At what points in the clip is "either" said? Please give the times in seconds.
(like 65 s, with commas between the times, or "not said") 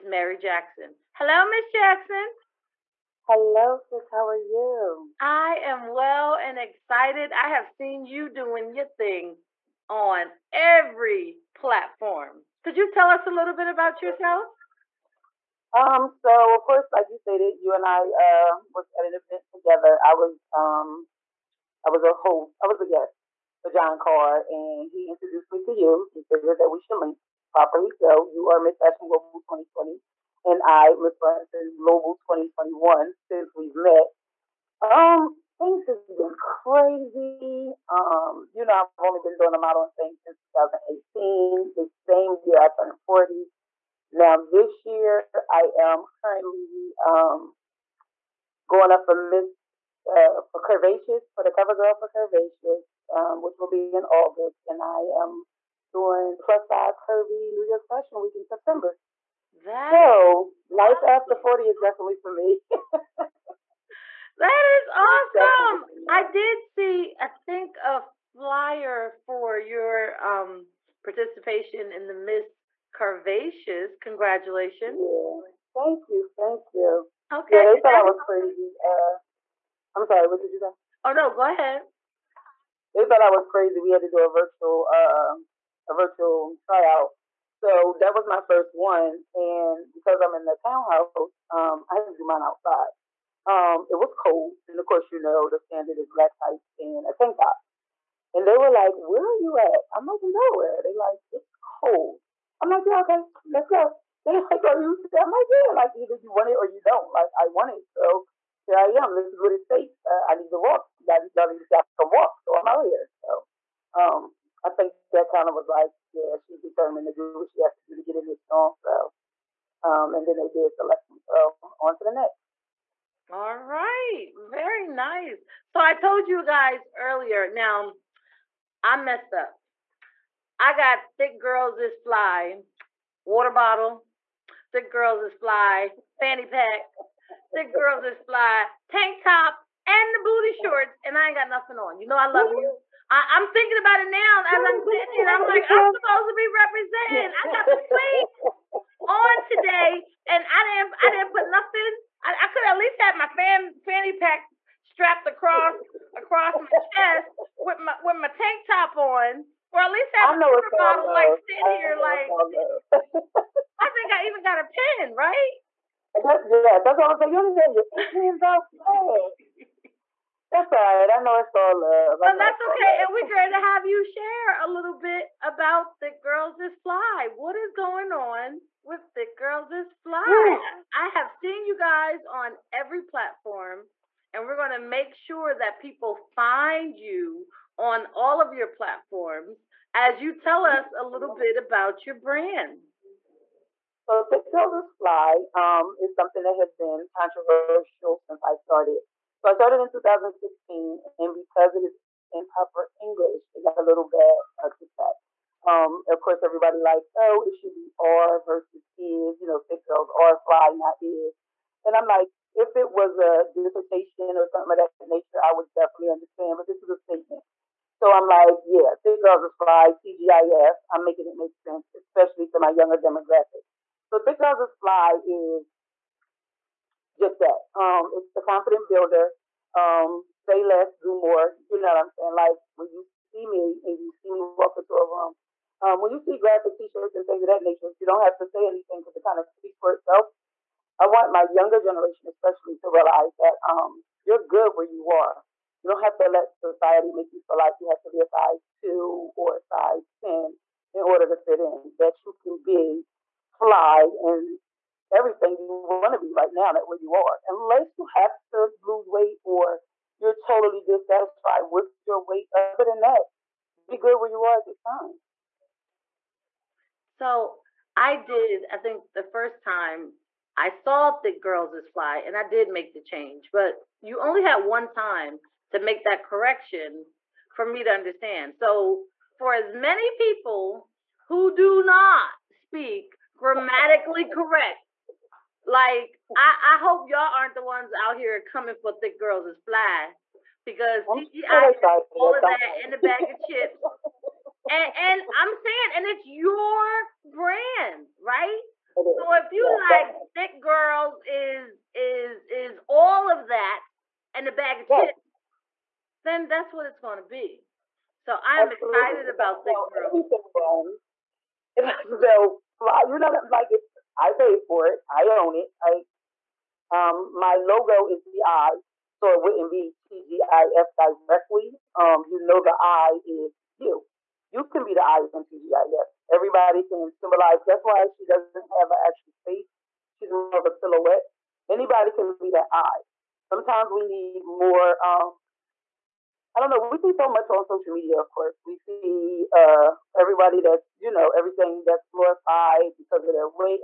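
105 s.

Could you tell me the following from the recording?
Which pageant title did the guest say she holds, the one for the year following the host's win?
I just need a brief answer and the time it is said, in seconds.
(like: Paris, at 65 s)
Miss Fashion Global 2021, at 30 s.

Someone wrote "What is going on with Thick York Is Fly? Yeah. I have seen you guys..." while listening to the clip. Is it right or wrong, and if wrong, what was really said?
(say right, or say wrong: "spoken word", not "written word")
wrong: "Girls", not "York".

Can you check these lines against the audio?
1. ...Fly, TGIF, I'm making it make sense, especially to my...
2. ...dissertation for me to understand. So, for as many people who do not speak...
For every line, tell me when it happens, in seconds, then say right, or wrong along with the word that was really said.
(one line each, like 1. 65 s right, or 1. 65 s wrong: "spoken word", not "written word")
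1. 219 s right
2. 276 s wrong: "correction", not "dissertation".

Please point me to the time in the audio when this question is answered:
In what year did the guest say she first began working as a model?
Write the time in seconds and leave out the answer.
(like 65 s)
40 s.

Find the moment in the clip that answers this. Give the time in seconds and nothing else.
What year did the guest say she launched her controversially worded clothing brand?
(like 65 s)
199 s.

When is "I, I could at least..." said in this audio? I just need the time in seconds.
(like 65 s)
152 s.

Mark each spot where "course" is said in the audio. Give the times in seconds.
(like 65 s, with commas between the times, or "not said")
16 s, 94 s, 206 s, 338 s.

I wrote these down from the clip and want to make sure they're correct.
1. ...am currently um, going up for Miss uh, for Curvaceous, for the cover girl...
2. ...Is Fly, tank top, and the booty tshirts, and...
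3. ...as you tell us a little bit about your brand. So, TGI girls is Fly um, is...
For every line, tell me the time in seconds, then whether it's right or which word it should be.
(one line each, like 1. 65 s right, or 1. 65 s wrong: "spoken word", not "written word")
1. 45 s right
2. 138 s wrong: "shorts", not "tshirts"
3. 189 s wrong: "Thick", not "TGI".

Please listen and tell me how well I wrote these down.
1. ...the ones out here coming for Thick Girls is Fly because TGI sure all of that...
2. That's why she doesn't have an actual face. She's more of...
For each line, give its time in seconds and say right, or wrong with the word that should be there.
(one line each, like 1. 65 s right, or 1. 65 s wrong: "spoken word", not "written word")
1. 287 s right
2. 327 s right.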